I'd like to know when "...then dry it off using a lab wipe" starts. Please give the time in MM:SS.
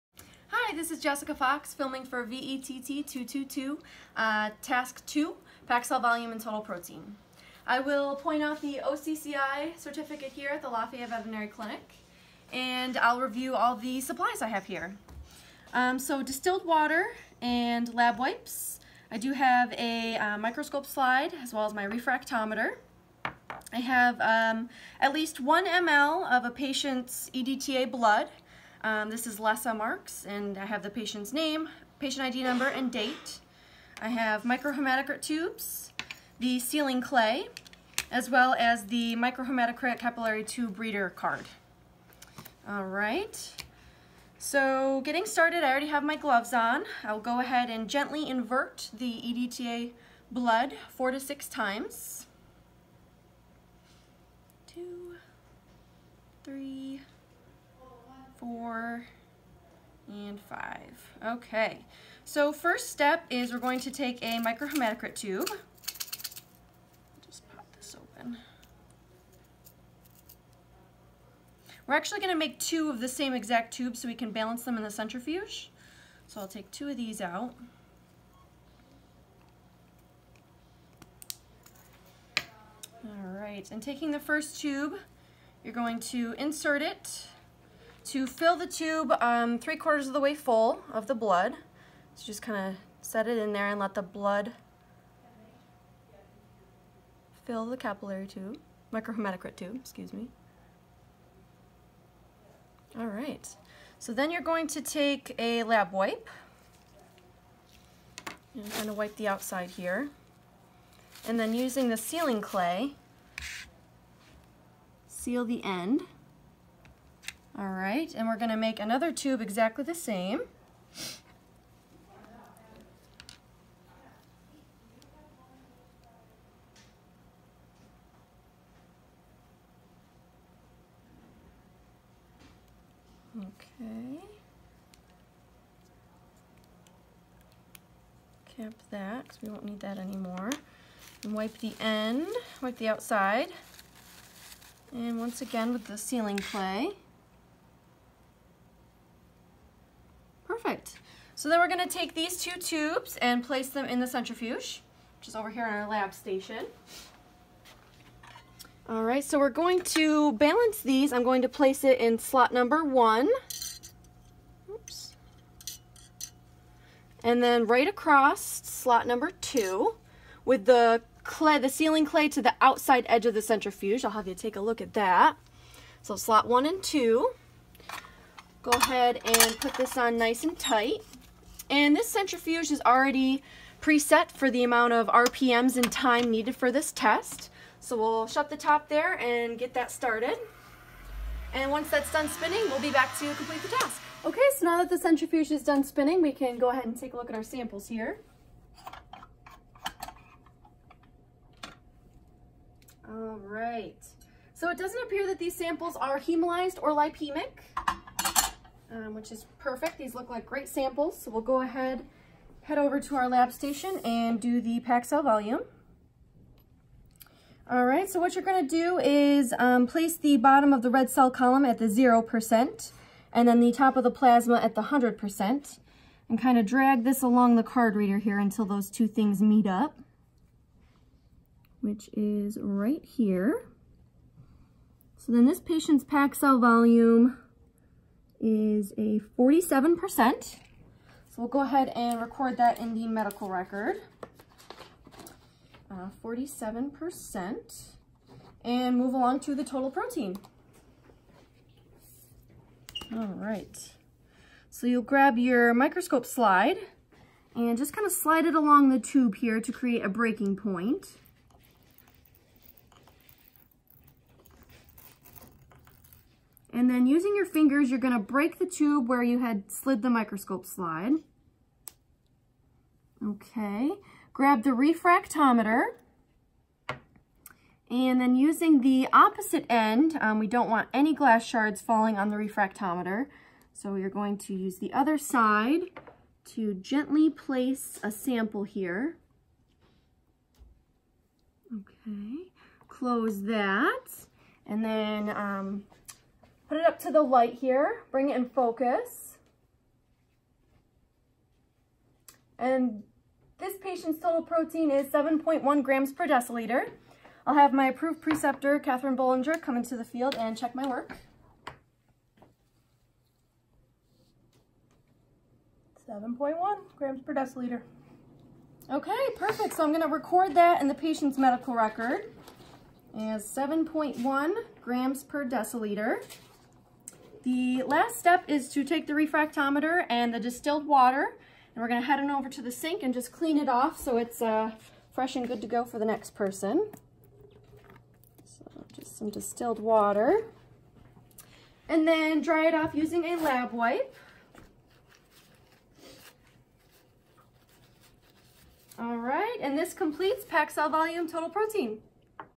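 05:42.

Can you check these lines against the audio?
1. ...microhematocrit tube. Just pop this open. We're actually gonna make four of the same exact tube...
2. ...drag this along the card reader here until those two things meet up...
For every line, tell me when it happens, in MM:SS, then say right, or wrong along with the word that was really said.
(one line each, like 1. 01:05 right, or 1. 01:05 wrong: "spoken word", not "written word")
1. 01:04 wrong: "two", not "four"
2. 03:46 right.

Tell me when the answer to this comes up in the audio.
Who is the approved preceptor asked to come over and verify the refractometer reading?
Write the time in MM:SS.
05:08.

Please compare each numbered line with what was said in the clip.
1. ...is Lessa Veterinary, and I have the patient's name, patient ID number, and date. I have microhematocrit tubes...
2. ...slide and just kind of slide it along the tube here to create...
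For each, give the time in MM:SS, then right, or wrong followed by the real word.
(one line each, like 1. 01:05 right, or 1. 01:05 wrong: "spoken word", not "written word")
1. 00:29 wrong: "Marks", not "Veterinary"
2. 04:16 right.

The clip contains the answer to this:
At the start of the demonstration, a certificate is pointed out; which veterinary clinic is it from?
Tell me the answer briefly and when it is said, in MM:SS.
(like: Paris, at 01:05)
Lafayette Veterinary Clinic, at 00:10.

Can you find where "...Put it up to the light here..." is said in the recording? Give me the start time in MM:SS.
04:56.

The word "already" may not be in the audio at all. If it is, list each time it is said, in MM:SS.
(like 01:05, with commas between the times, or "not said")
00:45, 03:02.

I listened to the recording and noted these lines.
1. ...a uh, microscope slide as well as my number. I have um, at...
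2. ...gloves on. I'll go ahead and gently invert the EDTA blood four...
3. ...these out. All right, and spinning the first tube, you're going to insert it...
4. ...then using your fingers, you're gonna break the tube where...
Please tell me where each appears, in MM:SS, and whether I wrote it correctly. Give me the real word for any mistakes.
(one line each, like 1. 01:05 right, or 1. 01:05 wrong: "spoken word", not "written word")
1. 00:19 wrong: "refractometer", not "number"
2. 00:46 right
3. 01:16 wrong: "taking", not "spinning"
4. 04:26 right.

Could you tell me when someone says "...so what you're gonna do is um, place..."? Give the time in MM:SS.
03:38.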